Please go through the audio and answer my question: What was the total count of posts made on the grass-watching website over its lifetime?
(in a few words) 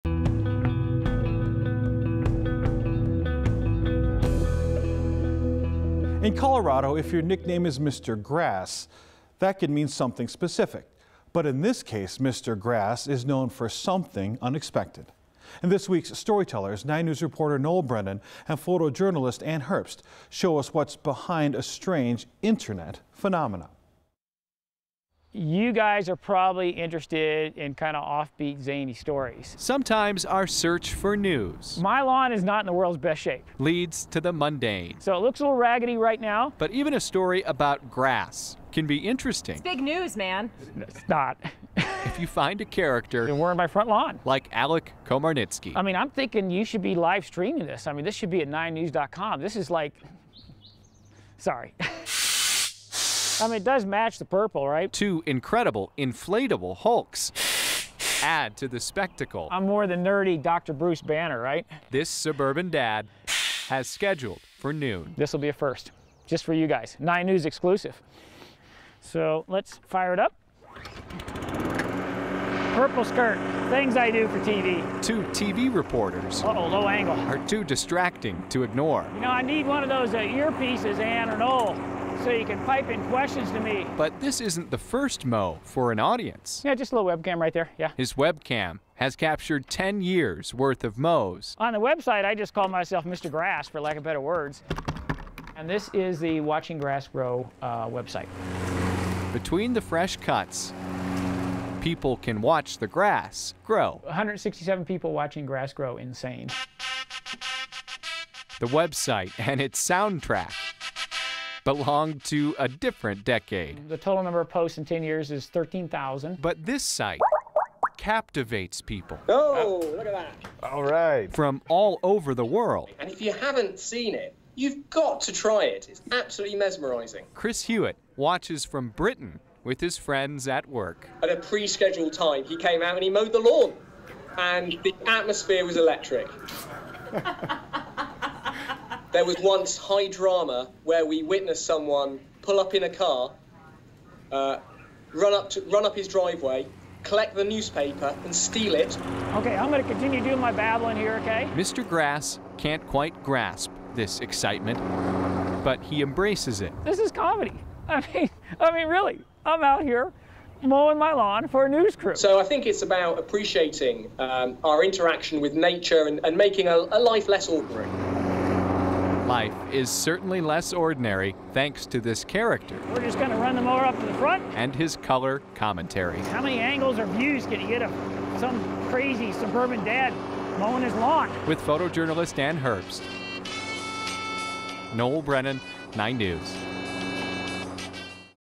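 13,000.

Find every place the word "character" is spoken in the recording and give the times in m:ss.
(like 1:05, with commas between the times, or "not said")
0:42, 2:52.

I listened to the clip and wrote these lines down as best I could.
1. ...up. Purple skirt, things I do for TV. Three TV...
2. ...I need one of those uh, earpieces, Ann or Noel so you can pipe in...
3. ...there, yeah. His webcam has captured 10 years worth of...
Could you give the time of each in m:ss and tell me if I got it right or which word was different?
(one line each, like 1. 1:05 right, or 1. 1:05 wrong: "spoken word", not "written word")
1. 1:10 wrong: "Two", not "Three"
2. 1:19 right
3. 1:27 right.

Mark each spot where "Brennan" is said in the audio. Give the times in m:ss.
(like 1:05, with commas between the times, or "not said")
0:17, 3:05.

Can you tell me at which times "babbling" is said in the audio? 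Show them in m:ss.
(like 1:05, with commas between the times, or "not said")
2:30.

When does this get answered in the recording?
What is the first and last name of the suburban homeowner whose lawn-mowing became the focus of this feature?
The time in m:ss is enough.
0:44.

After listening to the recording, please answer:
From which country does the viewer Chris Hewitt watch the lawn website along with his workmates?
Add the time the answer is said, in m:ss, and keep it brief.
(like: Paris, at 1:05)
Britain, at 2:08.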